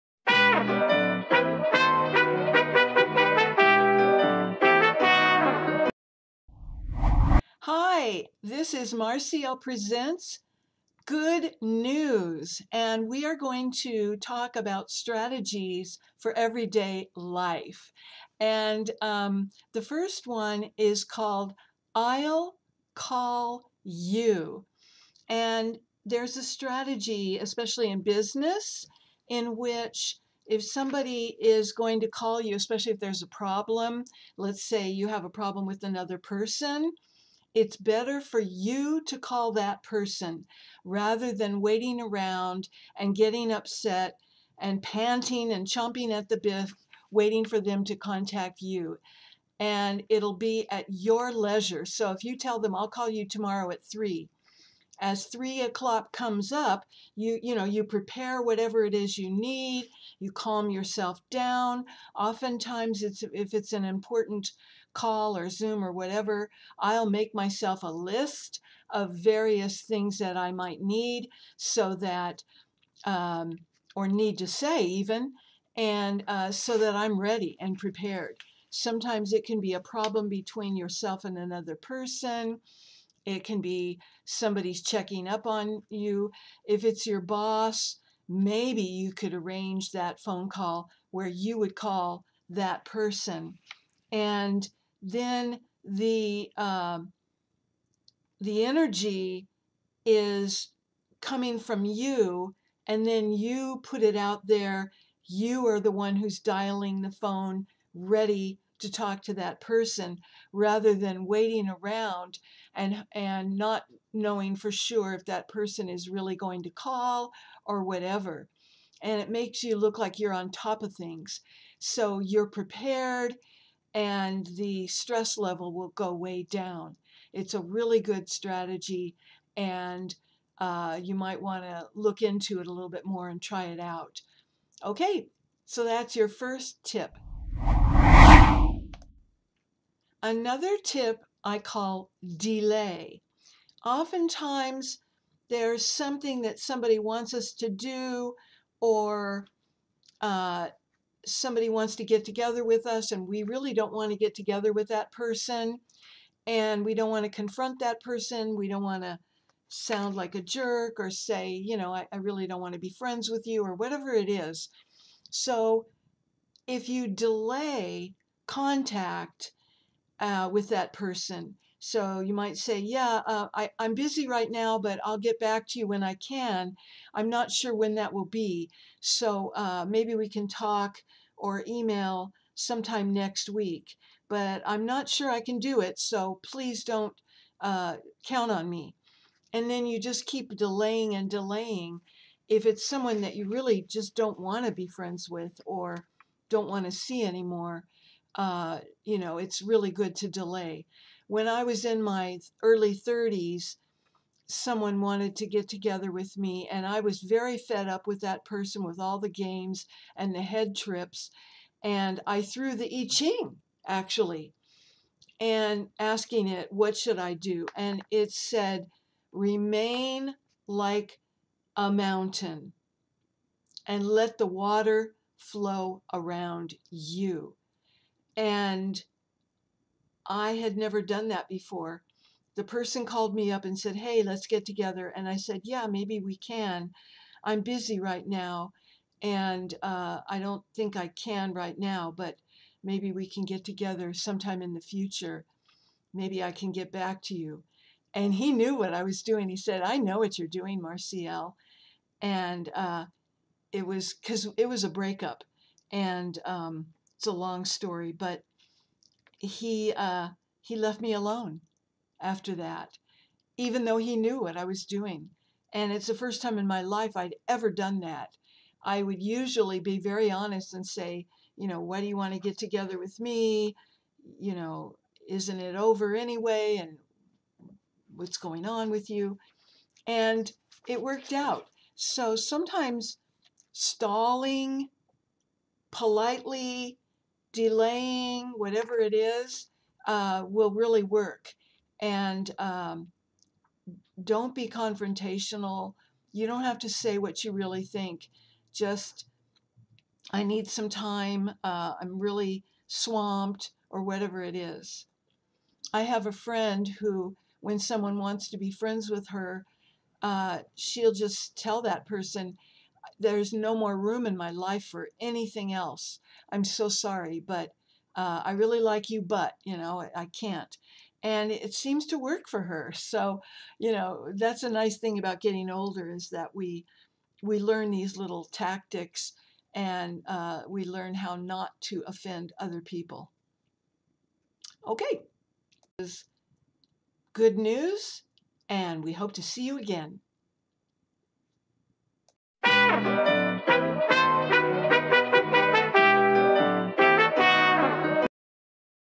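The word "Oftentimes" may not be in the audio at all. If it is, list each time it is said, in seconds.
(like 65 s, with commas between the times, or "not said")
62 s, 143 s.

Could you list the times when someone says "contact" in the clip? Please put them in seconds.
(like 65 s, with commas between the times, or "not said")
47 s, 168 s.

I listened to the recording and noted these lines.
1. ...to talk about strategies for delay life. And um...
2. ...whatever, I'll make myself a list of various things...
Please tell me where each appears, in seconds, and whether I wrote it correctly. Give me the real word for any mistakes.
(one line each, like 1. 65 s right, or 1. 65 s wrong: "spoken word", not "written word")
1. 13 s wrong: "everyday", not "delay"
2. 65 s right.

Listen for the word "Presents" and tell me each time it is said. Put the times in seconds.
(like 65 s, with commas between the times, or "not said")
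9 s.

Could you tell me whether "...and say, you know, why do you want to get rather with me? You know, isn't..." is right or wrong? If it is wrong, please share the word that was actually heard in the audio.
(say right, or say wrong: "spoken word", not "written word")
wrong: "together", not "rather".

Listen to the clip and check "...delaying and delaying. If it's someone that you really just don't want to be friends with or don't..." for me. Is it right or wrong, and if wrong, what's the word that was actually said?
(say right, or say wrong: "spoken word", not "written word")
right.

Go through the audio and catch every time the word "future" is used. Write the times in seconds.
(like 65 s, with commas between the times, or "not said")
244 s.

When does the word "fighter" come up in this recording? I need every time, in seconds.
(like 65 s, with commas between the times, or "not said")
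not said.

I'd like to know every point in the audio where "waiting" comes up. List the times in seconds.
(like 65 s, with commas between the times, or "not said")
41 s, 47 s, 111 s.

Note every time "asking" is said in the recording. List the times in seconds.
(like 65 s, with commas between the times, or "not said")
215 s.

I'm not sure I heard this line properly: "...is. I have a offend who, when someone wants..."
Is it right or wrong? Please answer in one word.
wrong.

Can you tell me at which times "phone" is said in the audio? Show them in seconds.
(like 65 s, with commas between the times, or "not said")
90 s, 107 s.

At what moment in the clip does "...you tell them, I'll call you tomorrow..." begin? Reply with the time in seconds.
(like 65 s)
52 s.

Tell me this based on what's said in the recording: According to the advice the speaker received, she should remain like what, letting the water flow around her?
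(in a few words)
A mountain.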